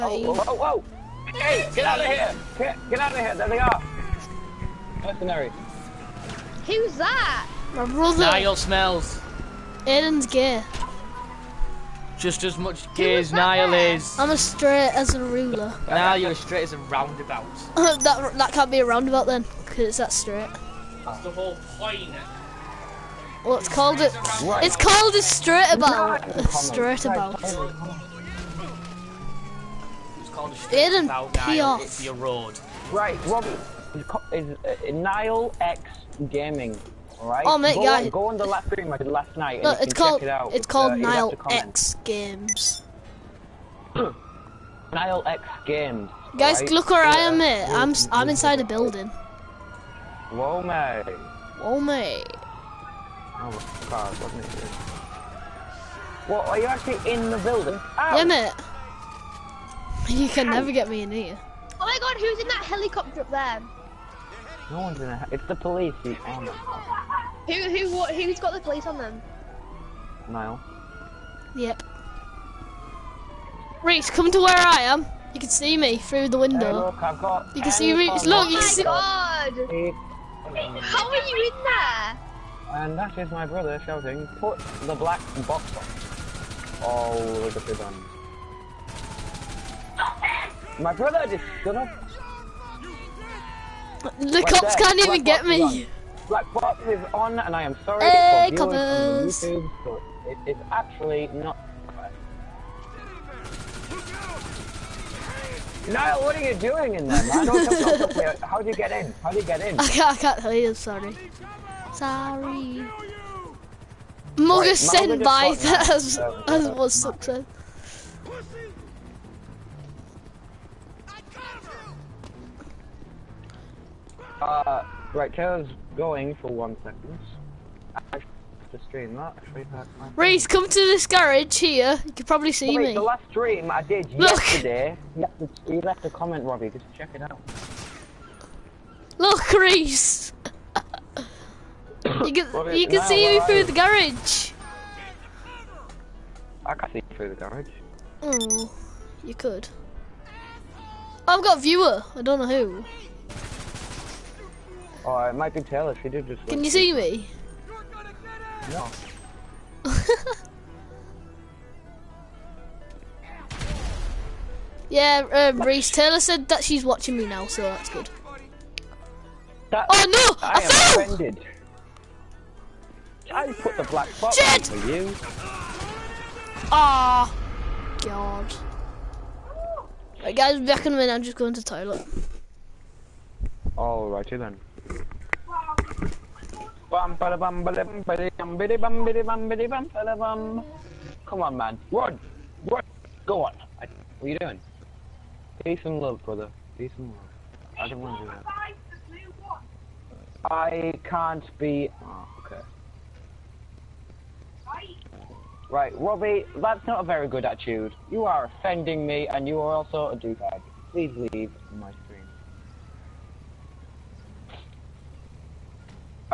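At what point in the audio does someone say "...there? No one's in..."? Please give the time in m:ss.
1:03.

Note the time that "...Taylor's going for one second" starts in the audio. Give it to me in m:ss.
2:05.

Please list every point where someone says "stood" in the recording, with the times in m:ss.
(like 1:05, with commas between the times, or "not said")
1:31.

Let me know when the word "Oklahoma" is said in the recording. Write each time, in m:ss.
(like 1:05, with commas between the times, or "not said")
not said.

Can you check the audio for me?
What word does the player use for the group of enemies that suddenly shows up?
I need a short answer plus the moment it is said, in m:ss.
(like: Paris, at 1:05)
Mercenaries, at 0:05.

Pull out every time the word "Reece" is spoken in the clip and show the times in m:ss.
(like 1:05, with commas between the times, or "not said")
1:13, 1:17, 2:10, 2:19, 2:45.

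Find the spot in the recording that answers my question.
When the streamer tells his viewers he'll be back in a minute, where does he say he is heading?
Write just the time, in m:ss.
3:01.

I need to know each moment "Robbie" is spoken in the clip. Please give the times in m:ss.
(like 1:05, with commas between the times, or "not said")
0:33, 2:16, 2:22, 3:25.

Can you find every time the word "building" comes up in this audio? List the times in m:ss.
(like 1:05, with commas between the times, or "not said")
0:48, 0:57.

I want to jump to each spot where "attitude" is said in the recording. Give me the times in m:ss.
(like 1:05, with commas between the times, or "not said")
3:27.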